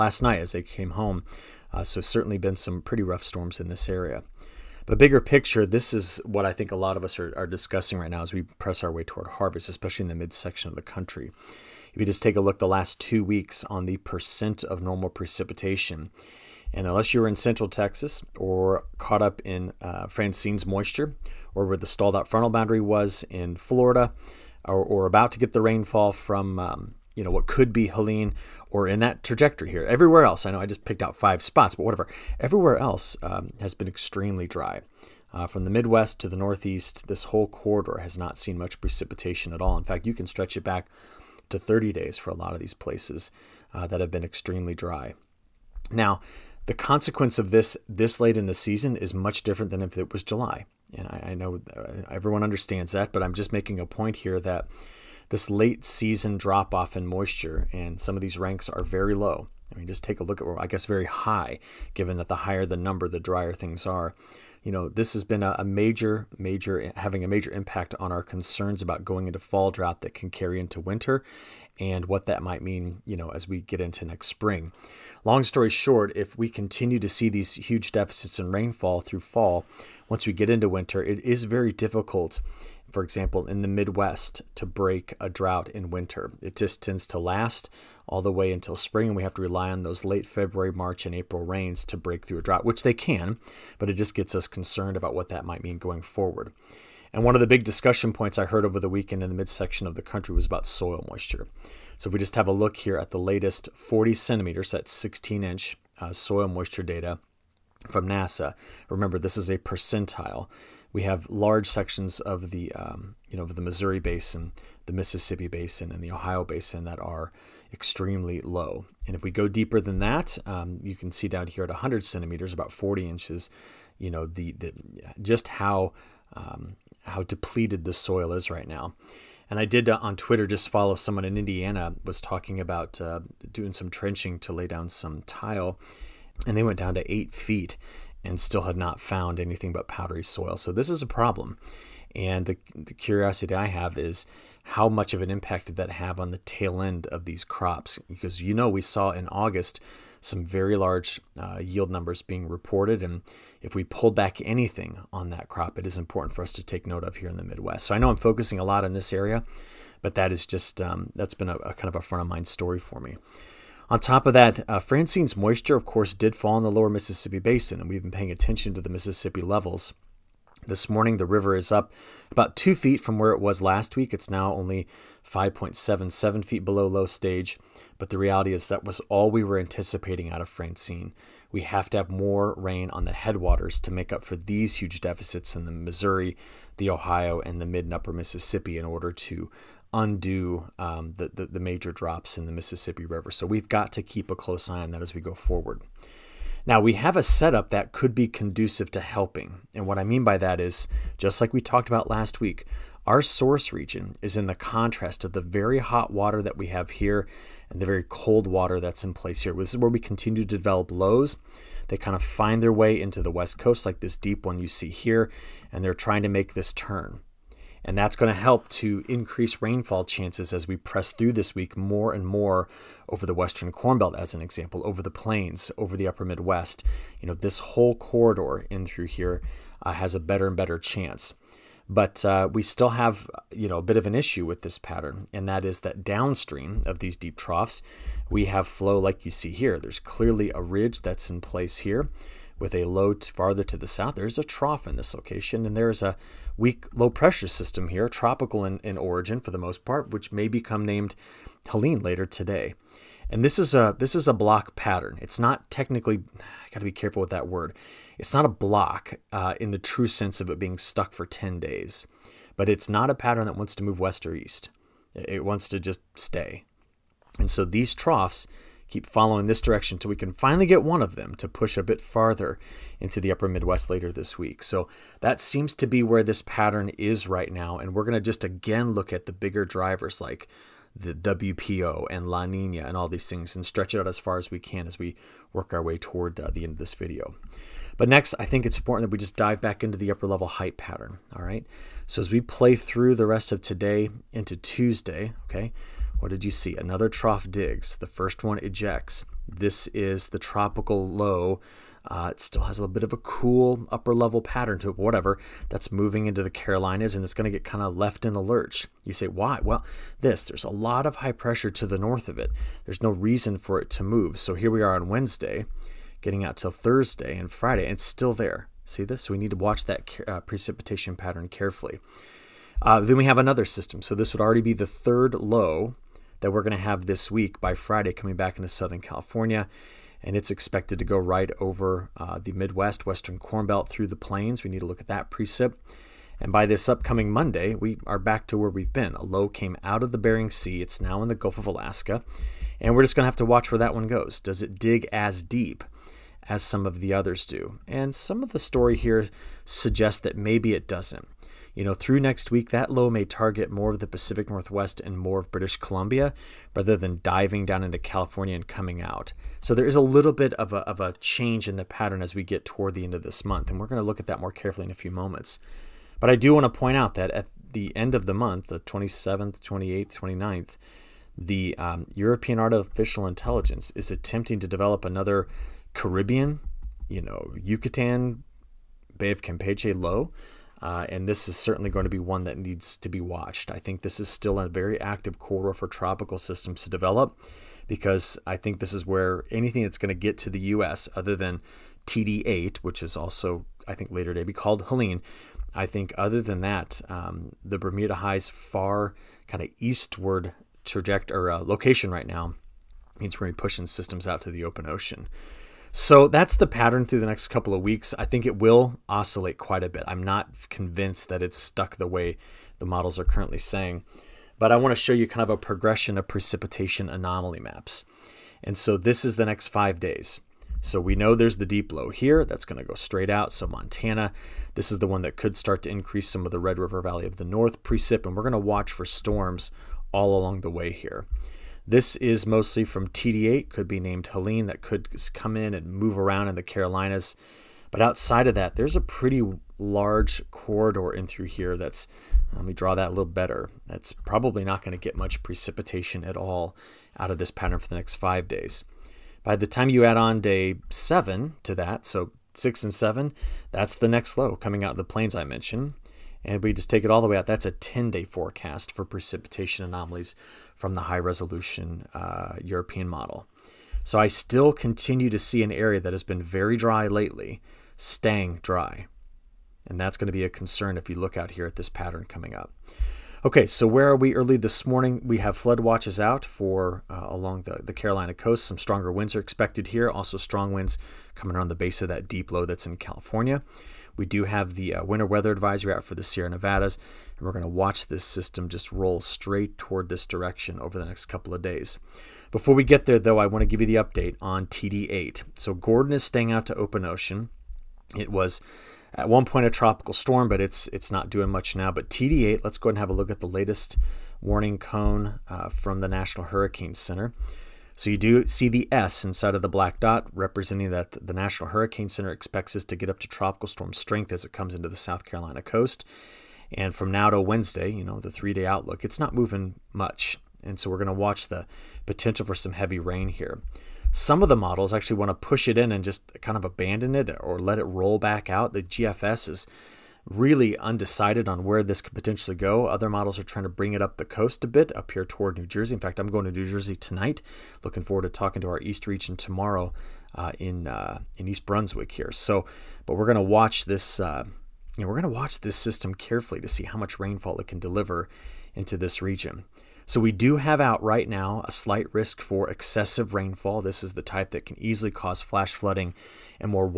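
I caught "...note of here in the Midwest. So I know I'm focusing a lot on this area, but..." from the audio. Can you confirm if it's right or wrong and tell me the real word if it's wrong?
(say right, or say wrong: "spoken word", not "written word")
right.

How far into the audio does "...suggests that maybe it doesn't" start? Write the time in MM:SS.
05:49.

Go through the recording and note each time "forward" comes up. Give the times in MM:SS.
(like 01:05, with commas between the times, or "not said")
01:36, 03:15, 08:58.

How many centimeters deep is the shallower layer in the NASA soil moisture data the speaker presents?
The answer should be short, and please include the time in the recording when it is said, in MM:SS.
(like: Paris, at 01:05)
40 centimeters, at 01:43.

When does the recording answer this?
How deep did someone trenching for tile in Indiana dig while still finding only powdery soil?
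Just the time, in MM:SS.
02:17.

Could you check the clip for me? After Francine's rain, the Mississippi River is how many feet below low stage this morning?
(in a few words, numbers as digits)
5.77 feet.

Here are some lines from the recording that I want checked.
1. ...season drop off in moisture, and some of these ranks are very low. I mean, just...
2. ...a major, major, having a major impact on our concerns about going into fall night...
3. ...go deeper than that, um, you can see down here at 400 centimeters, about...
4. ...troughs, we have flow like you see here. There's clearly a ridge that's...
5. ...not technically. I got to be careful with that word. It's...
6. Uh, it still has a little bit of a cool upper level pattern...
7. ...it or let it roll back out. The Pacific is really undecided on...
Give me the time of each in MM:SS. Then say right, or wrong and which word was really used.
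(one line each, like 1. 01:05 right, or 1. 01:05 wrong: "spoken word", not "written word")
1. 00:55 right
2. 01:05 wrong: "drought", not "night"
3. 01:59 wrong: "100", not "400"
4. 03:57 right
5. 04:15 right
6. 05:02 right
7. 08:47 wrong: "GFS", not "Pacific".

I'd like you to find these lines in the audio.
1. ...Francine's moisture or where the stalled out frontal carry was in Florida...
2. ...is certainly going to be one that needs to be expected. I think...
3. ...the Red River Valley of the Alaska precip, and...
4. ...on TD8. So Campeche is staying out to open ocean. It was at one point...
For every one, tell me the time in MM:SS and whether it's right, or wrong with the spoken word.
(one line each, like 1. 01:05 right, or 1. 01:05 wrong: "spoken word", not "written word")
1. 00:20 wrong: "boundary", not "carry"
2. 06:21 wrong: "watched", not "expected"
3. 07:06 wrong: "North", not "Alaska"
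4. 08:14 wrong: "Gordon", not "Campeche".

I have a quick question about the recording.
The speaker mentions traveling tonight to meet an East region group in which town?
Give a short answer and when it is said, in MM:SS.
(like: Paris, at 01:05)
East Brunswick, at 09:01.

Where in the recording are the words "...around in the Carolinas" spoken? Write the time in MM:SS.
07:16.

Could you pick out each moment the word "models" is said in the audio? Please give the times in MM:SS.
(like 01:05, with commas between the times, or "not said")
06:52, 07:43, 08:44, 08:53.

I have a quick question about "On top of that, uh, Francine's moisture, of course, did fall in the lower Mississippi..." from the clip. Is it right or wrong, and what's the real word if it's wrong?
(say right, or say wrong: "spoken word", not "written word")
right.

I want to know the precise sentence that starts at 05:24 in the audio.
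So this would already be the third low that we're going to have this week by Friday coming back into Southern California.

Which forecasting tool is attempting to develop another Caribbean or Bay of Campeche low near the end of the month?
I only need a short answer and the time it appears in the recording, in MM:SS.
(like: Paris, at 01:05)
European Artificial Intelligence, at 06:12.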